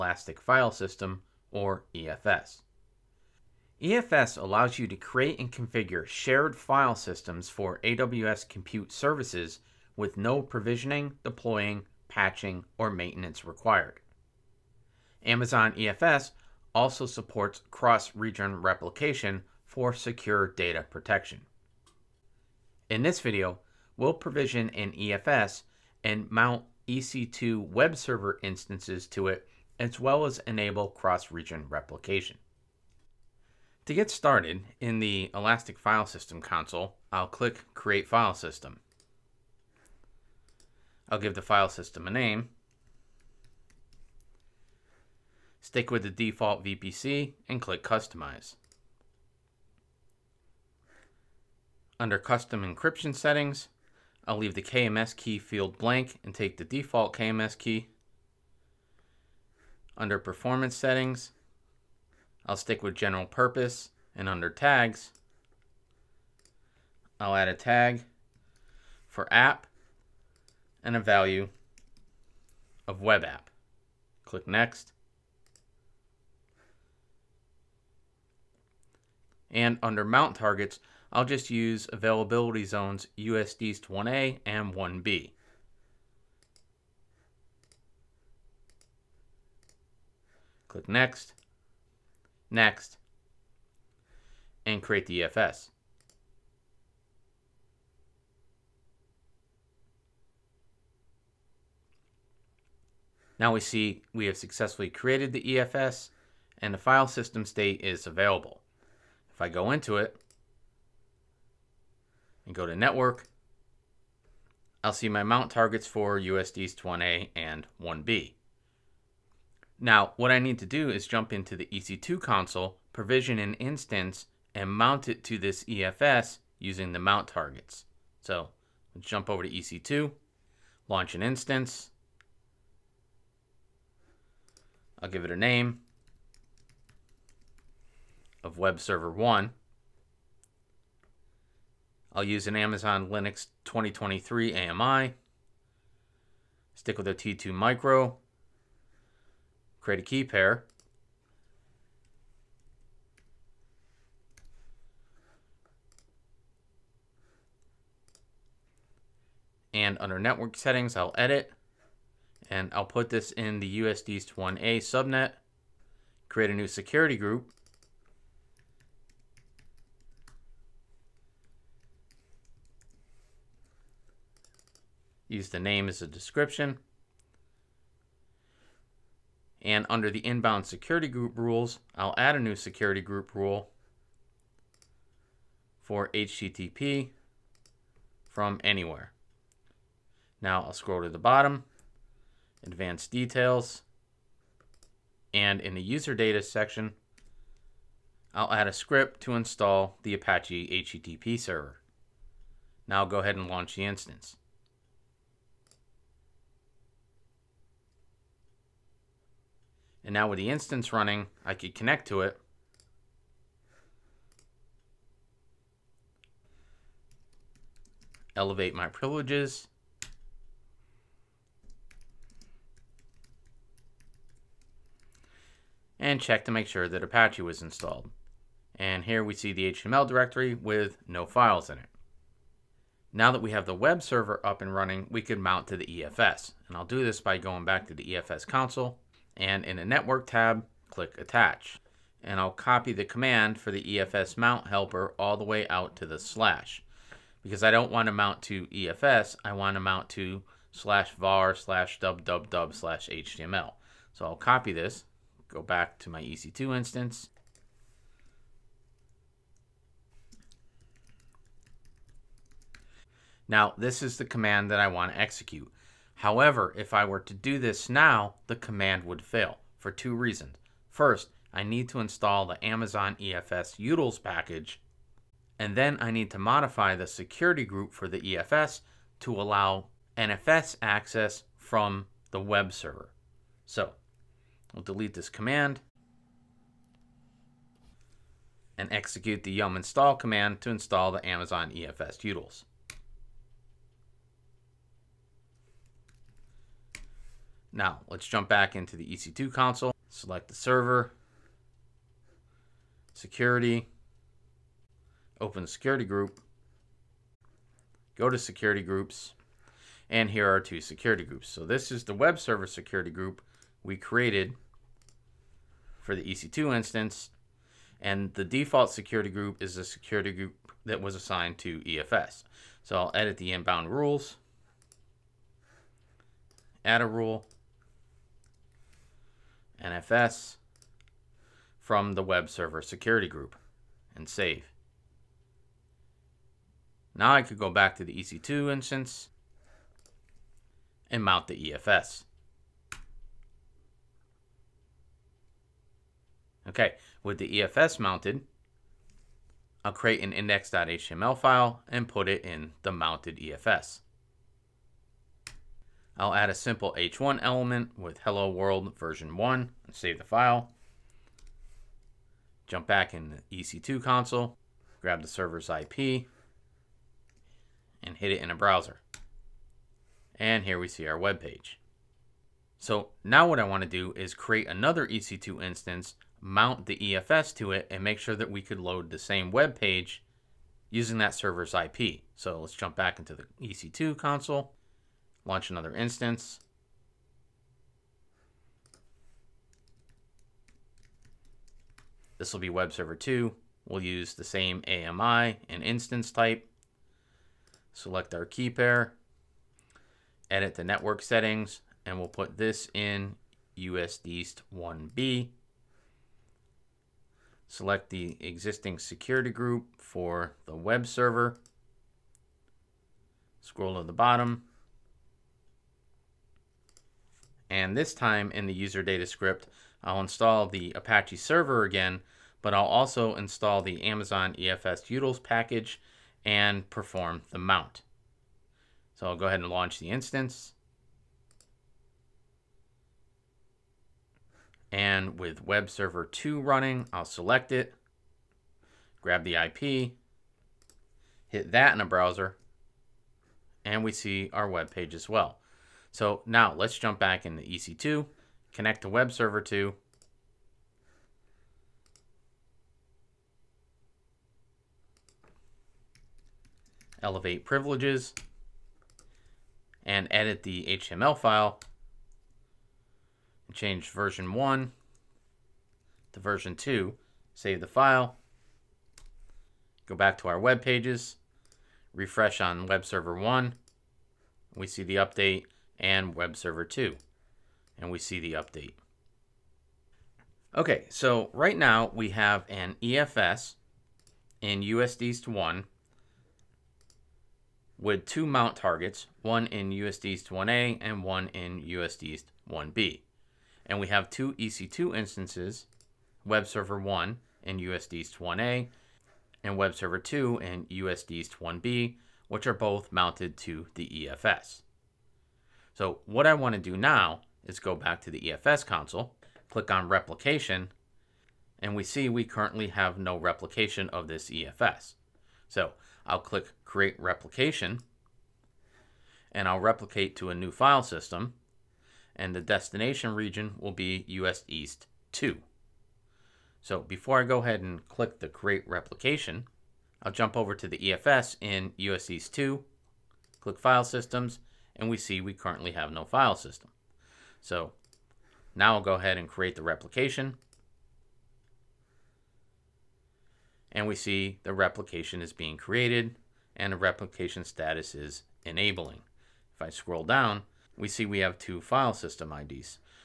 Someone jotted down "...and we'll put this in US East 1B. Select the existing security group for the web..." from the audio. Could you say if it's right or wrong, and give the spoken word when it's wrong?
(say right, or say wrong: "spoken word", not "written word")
right.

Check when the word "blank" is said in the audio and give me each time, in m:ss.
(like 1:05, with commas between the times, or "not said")
0:55.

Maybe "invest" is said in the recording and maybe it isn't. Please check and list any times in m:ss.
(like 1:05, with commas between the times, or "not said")
not said.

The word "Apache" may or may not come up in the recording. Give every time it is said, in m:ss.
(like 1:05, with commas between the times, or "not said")
3:20, 3:47, 7:00.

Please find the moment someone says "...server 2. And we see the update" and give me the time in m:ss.
7:56.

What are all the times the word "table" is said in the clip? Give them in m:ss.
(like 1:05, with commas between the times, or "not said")
not said.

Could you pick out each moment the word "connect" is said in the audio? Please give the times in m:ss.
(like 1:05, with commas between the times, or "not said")
3:31, 7:28.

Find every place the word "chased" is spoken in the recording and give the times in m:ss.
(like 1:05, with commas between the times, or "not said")
not said.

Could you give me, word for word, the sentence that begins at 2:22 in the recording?
I'll use an Amazon Linux 2023 AMI.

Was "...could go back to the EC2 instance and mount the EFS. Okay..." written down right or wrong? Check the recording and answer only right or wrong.
right.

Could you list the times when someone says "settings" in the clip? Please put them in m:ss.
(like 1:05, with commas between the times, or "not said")
0:53, 1:00, 2:40, 6:41.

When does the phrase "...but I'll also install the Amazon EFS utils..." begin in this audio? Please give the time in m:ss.
7:02.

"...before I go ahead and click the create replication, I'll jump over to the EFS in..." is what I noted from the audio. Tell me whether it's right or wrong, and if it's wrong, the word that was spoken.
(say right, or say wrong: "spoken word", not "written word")
right.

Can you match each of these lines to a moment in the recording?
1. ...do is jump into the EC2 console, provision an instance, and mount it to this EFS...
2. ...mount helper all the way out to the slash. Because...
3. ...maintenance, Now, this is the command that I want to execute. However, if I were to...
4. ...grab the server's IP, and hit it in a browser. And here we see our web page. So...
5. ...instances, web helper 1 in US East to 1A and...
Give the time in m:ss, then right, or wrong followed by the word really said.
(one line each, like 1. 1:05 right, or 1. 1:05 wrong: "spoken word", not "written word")
1. 2:00 right
2. 4:04 right
3. 4:16 wrong: "instance", not "maintenance"
4. 6:05 right
5. 8:15 wrong: "server", not "helper".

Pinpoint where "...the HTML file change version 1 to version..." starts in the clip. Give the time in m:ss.
7:40.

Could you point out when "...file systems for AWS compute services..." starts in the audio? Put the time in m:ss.
0:06.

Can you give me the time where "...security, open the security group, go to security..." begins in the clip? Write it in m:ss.
5:03.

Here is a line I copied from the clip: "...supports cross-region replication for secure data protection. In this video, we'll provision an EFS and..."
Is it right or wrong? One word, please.
right.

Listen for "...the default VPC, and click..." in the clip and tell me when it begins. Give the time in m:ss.
0:46.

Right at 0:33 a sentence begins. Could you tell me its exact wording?
To get started, in the Elastic File System console, I'll click Create File System.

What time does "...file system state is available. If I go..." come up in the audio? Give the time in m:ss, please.
1:46.